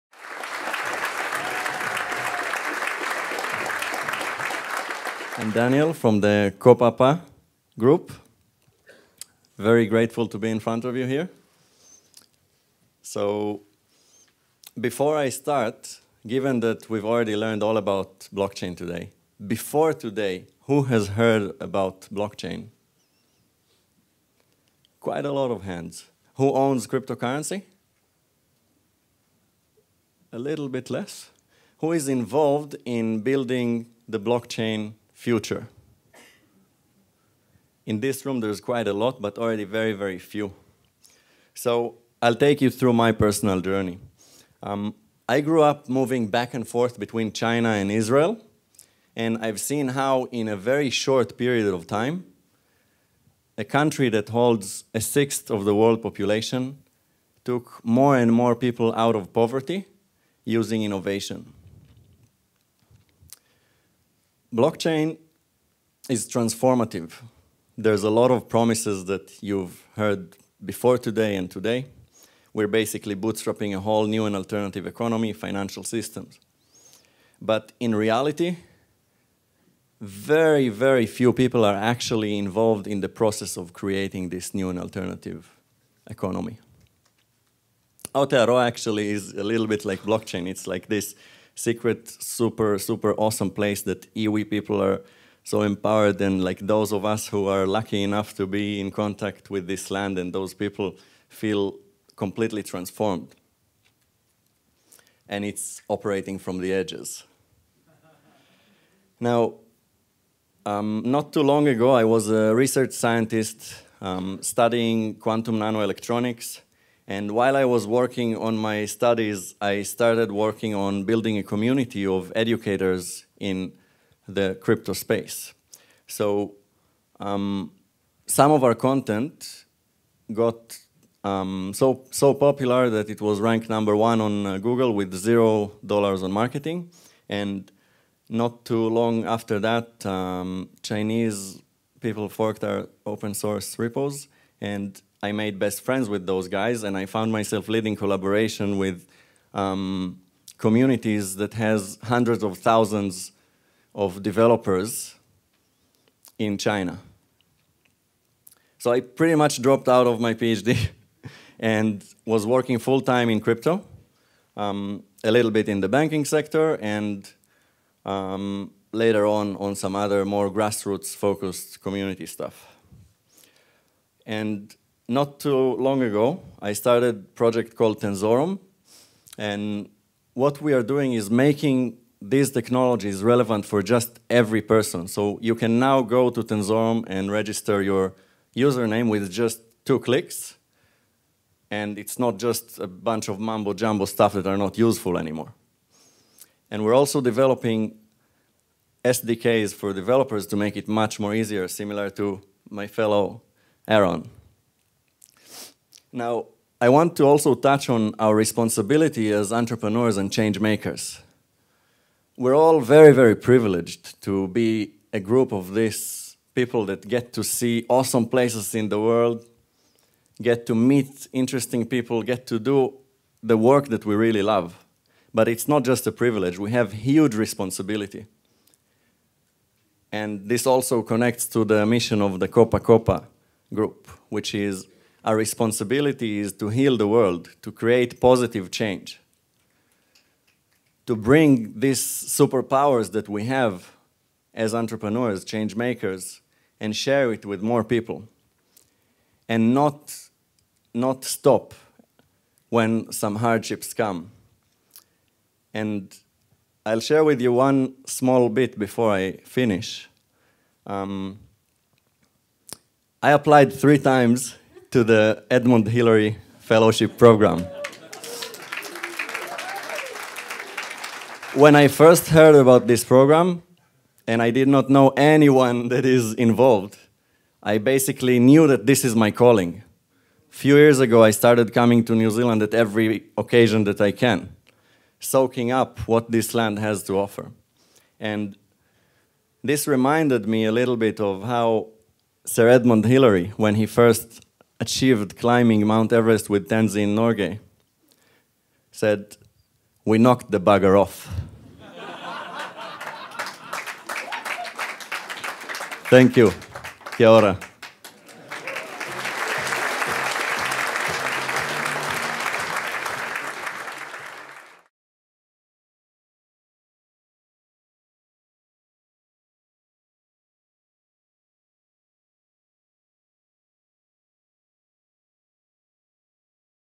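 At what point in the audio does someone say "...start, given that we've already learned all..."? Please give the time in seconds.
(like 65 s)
15 s.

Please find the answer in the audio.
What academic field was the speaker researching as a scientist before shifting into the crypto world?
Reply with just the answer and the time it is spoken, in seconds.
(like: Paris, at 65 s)
Quantum nanoelectronics, at 115 s.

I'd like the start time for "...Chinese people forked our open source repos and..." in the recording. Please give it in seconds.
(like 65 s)
140 s.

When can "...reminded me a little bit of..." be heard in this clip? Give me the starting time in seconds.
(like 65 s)
289 s.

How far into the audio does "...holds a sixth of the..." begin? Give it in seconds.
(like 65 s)
54 s.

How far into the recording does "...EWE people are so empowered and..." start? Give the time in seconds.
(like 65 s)
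94 s.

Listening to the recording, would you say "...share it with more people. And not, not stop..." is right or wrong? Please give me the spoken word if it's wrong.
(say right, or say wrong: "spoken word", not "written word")
right.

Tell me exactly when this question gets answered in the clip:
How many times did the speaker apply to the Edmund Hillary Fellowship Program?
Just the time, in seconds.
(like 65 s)
263 s.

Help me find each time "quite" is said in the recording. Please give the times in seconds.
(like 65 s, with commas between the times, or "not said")
24 s, 38 s.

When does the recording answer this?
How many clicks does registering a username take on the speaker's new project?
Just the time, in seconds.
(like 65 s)
189 s.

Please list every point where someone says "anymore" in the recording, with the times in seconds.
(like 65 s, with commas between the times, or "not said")
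195 s.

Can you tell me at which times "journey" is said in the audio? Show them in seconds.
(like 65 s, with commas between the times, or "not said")
43 s.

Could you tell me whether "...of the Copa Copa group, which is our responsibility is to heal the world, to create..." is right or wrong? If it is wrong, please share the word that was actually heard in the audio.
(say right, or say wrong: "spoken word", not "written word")
right.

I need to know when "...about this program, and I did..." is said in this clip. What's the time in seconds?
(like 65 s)
272 s.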